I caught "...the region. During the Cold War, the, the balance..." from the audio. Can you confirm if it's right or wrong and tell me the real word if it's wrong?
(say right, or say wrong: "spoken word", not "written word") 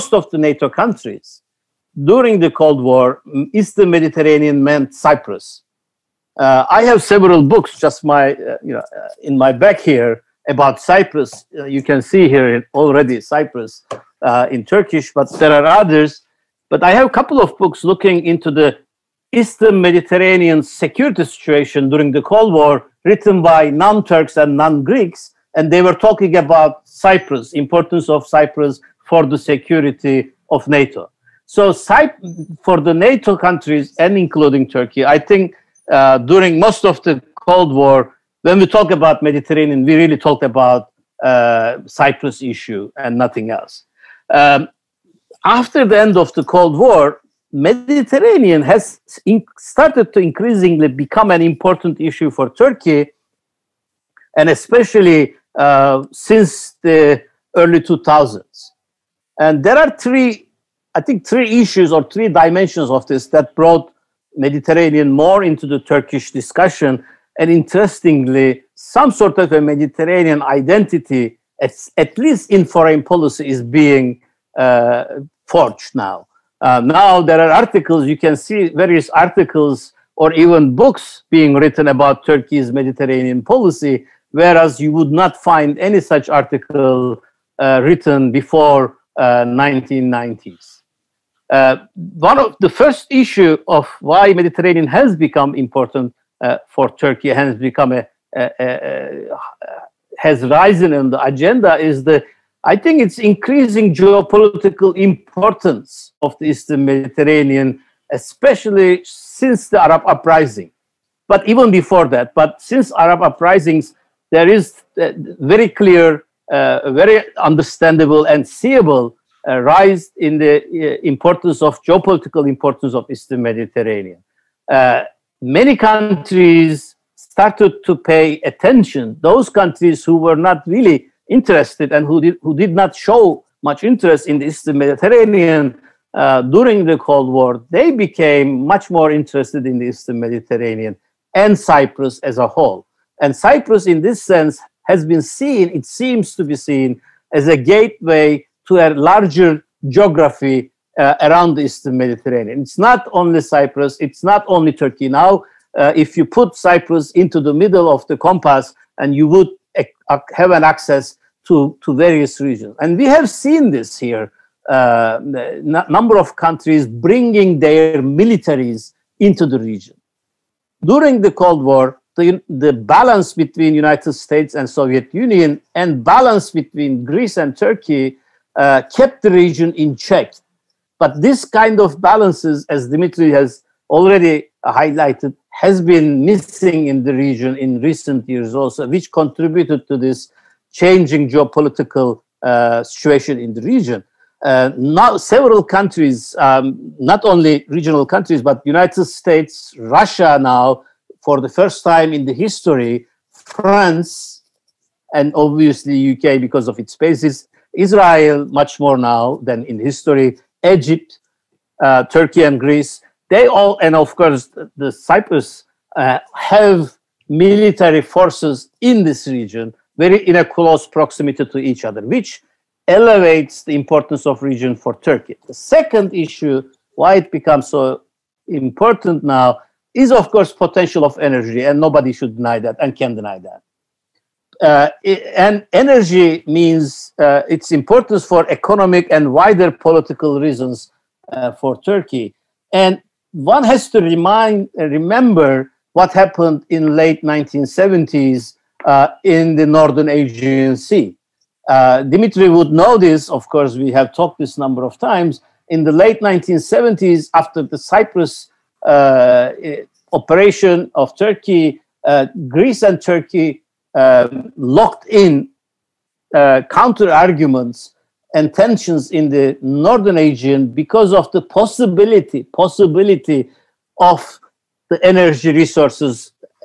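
right.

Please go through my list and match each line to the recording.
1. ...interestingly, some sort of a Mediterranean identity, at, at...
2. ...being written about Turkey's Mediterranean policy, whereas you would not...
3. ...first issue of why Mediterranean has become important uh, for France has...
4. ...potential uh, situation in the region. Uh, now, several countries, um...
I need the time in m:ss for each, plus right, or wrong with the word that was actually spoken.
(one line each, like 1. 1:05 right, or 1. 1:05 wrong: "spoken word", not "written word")
1. 1:07 right
2. 1:21 right
3. 1:32 wrong: "Turkey", not "France"
4. 3:11 wrong: "geopolitical", not "potential".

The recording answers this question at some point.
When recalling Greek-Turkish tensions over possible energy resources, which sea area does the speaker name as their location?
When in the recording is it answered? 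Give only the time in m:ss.
4:09.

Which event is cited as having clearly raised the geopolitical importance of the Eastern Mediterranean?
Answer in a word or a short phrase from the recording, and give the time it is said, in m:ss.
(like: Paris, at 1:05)
Arab uprisings, at 1:52.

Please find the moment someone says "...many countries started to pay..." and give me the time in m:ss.
2:05.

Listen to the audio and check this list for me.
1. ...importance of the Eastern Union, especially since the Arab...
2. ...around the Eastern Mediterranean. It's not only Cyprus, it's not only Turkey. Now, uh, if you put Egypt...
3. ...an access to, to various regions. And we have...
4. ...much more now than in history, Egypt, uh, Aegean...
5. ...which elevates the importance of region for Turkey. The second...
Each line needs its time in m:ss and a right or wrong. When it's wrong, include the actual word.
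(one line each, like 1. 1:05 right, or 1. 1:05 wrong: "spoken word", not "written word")
1. 1:44 wrong: "Mediterranean", not "Union"
2. 2:31 wrong: "Cyprus", not "Egypt"
3. 2:40 right
4. 3:28 wrong: "Turkey", not "Aegean"
5. 3:42 right.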